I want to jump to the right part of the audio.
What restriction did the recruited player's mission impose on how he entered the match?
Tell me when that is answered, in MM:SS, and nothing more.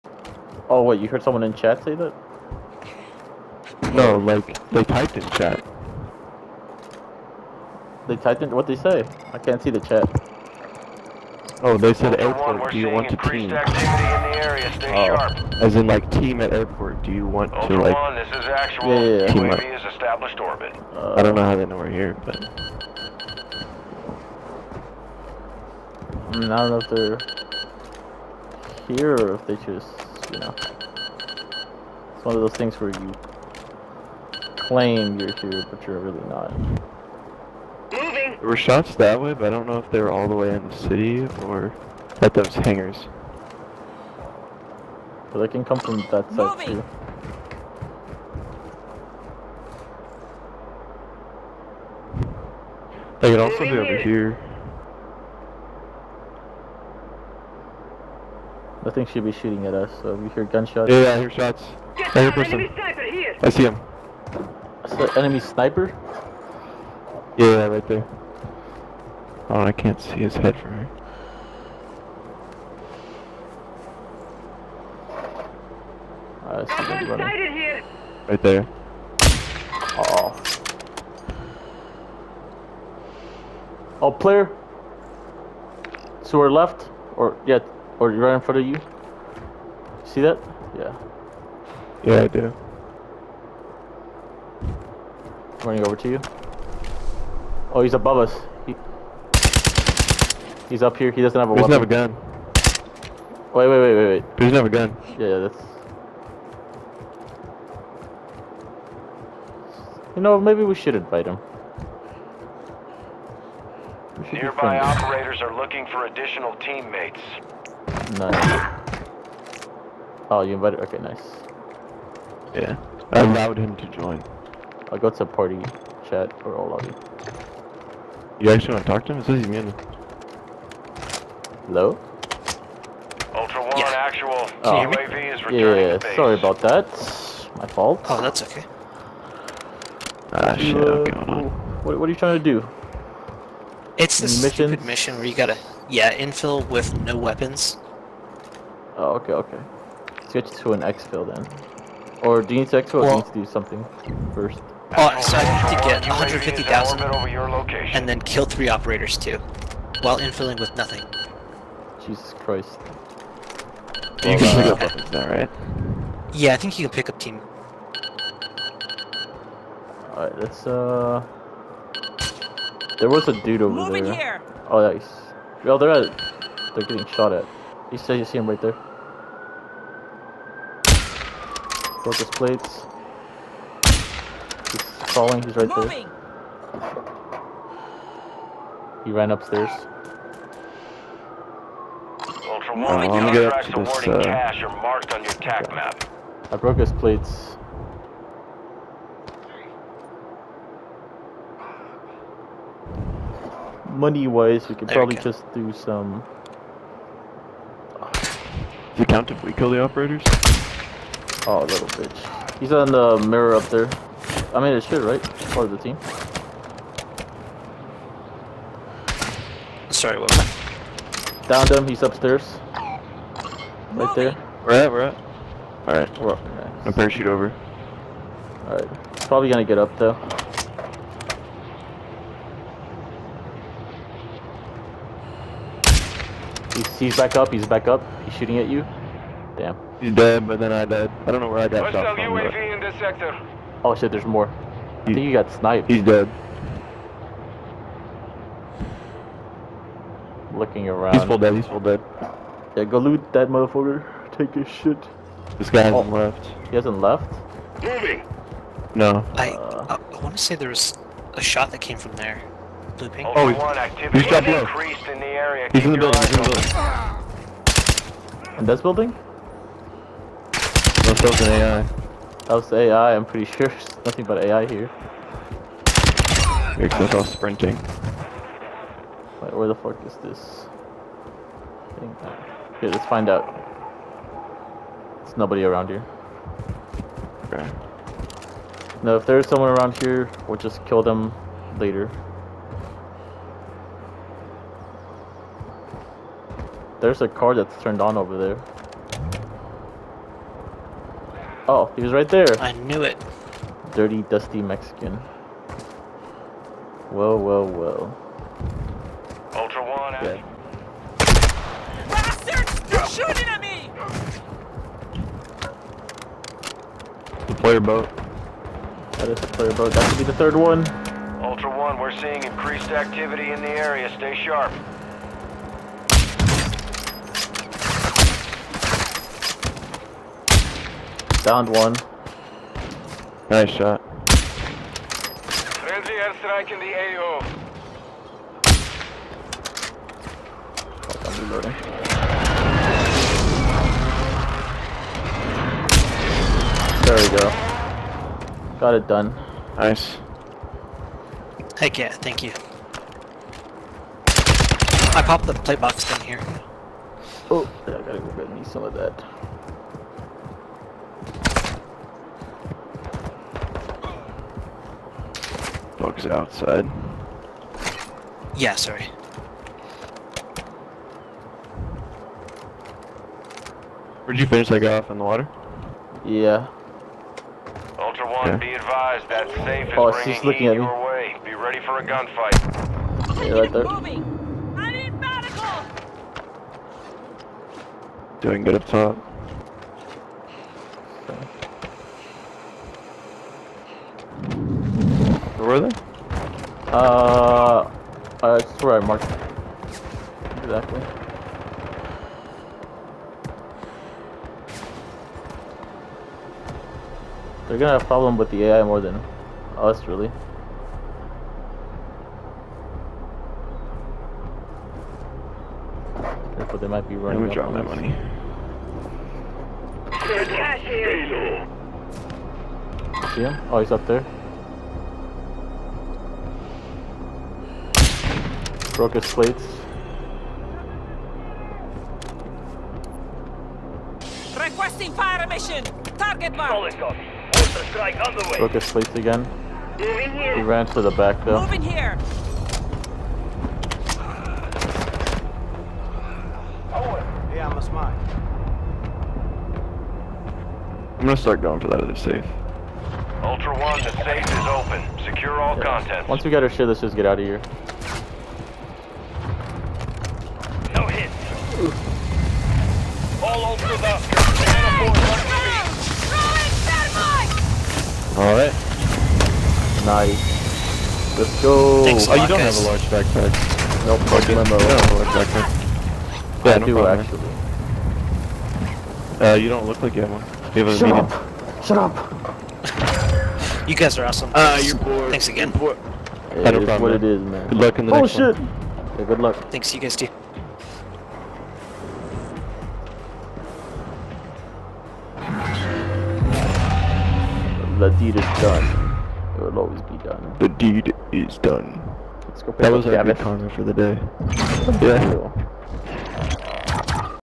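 02:27.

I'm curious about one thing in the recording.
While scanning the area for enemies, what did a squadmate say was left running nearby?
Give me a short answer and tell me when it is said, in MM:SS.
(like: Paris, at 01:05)
a car, at 04:57.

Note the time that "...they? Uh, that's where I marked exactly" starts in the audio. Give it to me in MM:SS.
06:35.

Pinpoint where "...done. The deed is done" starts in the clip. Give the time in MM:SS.
08:20.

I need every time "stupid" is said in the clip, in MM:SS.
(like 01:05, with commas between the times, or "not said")
02:24.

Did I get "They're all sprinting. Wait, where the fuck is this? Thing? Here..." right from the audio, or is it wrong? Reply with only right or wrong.
right.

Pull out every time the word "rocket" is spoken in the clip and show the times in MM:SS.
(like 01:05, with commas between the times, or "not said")
07:09, 07:18.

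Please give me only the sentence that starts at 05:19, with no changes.
That could be the third one.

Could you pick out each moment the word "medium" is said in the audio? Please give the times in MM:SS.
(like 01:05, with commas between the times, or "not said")
08:01.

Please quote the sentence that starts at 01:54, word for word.
Nearby operators are looking for additional teammates.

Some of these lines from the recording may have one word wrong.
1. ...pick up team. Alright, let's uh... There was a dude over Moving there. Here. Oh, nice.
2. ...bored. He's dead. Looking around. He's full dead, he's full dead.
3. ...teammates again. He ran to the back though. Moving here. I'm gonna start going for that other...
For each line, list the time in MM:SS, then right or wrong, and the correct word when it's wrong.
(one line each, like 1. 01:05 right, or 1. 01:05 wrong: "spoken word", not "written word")
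1. 02:46 right
2. 04:05 wrong: "sniped", not "bored"
3. 07:18 wrong: "slates", not "teammates".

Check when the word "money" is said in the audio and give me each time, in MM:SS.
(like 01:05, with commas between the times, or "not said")
03:23, 06:57.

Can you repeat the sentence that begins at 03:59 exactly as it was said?
He's dead, but then I died.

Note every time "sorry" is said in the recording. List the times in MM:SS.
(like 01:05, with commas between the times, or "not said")
02:16, 03:39, 06:08.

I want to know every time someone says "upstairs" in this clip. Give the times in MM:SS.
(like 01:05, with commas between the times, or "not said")
03:09, 03:42.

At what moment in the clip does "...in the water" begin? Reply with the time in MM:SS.
06:15.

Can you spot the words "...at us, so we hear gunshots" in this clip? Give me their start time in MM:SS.
00:59.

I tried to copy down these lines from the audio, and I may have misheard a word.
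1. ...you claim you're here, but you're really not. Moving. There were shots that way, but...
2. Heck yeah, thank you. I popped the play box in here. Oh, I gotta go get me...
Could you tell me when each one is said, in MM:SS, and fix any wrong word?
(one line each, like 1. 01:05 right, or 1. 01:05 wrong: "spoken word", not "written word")
1. 00:32 right
2. 05:51 right.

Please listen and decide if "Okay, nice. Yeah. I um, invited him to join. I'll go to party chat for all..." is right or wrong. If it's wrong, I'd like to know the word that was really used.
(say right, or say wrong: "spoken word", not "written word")
wrong: "allowed", not "invited".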